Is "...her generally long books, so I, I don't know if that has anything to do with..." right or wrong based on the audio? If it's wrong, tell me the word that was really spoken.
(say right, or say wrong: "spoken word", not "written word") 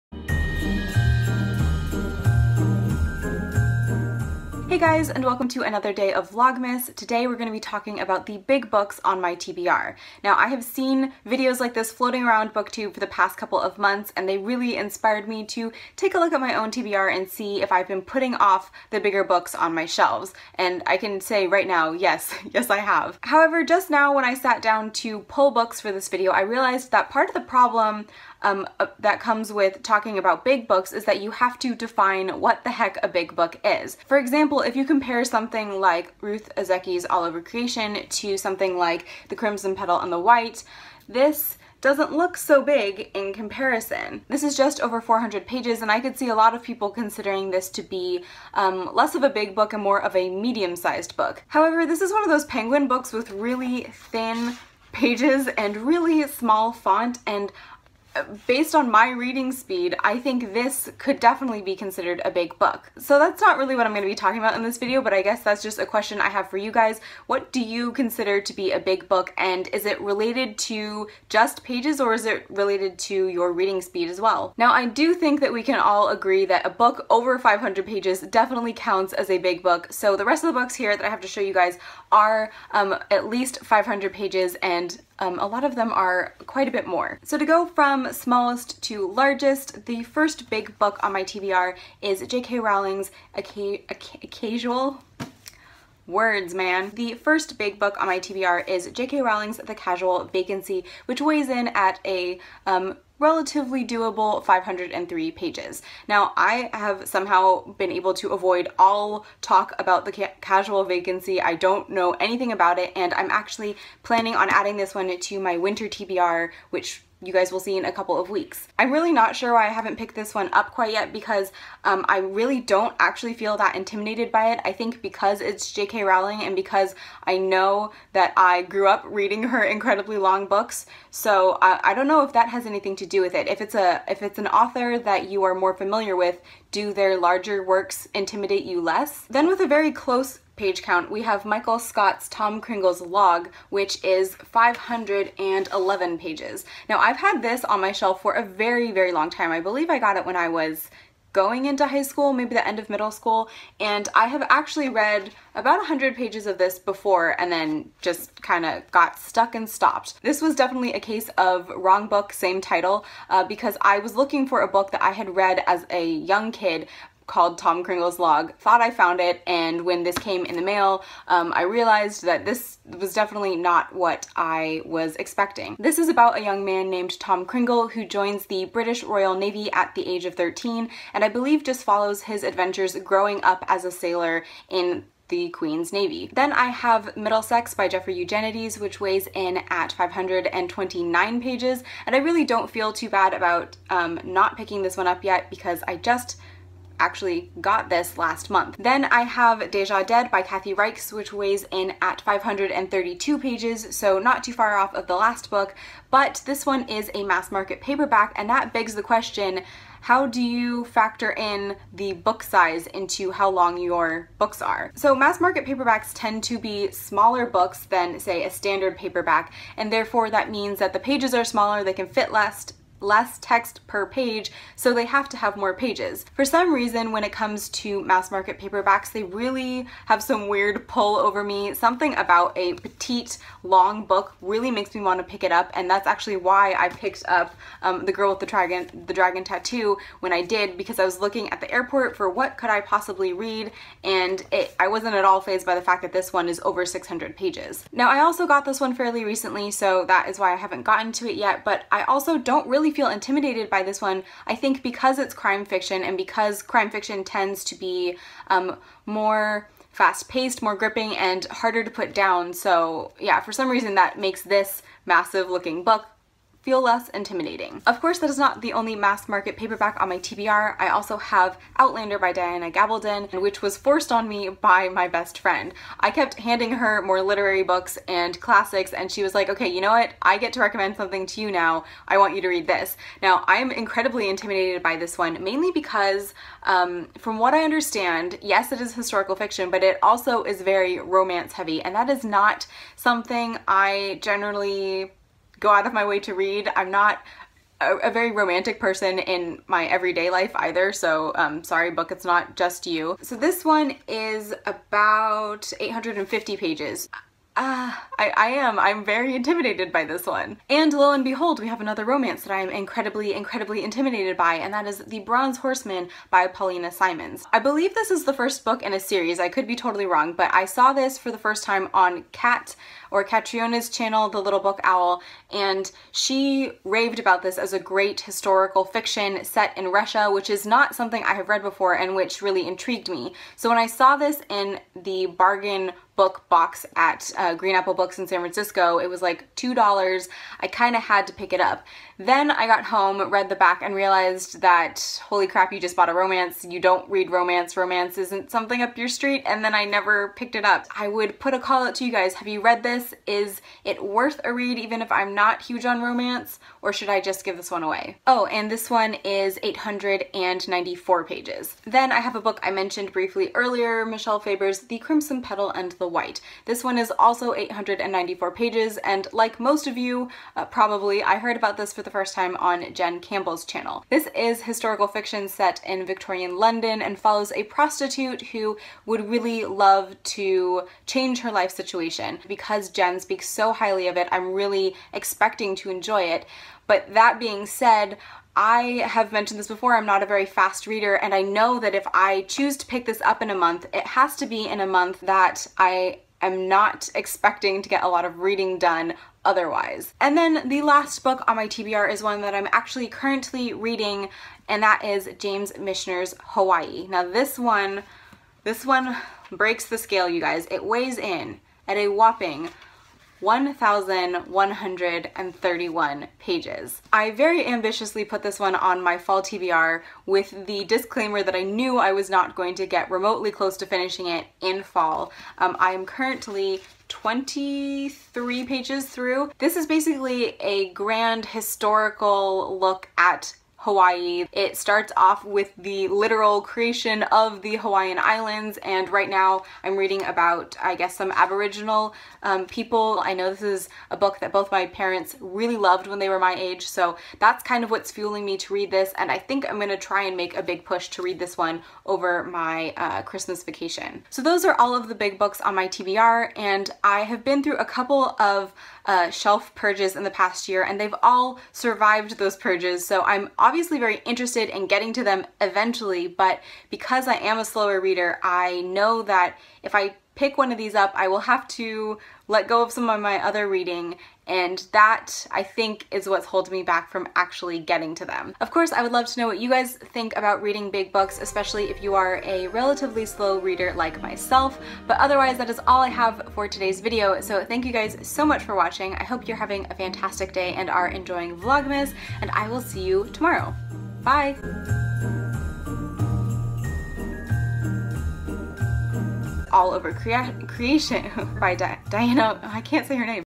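wrong: "incredibly", not "generally".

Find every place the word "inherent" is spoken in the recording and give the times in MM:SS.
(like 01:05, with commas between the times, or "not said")
not said.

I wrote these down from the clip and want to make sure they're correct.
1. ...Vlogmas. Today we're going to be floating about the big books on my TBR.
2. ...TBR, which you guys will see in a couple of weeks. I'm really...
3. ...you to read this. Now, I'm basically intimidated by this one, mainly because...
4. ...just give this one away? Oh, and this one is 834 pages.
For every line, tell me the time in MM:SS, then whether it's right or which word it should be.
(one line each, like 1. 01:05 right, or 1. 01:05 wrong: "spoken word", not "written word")
1. 00:06 wrong: "talking", not "floating"
2. 01:55 right
3. 04:42 wrong: "incredibly", not "basically"
4. 05:57 wrong: "894", not "834".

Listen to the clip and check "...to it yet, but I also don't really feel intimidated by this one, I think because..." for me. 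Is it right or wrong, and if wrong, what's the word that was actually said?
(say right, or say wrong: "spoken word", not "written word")
right.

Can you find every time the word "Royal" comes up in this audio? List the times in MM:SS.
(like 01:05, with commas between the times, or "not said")
02:59.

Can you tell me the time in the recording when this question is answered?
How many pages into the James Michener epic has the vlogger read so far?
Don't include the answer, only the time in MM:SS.
07:07.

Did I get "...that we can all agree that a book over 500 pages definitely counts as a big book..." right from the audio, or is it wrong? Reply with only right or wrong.
right.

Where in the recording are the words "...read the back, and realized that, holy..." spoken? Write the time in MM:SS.
05:43.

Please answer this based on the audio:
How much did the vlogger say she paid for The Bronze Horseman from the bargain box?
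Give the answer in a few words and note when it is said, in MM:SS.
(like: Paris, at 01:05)
$2, at 05:39.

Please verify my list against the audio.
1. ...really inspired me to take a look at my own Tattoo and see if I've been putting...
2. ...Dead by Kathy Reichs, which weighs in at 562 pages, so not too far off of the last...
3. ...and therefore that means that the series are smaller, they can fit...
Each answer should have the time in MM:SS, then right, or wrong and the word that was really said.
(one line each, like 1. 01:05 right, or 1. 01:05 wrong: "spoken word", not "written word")
1. 00:14 wrong: "TBR", not "Tattoo"
2. 03:20 wrong: "532", not "562"
3. 03:39 wrong: "pages", not "series".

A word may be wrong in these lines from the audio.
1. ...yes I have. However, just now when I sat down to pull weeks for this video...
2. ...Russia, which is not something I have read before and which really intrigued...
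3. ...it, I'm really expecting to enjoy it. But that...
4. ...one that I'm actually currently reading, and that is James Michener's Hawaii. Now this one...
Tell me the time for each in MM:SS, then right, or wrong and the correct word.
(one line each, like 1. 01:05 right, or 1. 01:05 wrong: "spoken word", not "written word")
1. 00:22 wrong: "books", not "weeks"
2. 05:29 right
3. 06:24 right
4. 06:42 right.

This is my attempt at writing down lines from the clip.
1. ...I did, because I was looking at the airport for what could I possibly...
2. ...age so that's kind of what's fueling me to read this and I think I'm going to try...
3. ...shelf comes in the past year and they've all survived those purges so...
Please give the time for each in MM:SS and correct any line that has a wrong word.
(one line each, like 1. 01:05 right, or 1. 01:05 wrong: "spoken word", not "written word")
1. 04:00 right
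2. 07:26 right
3. 07:39 wrong: "purges", not "comes".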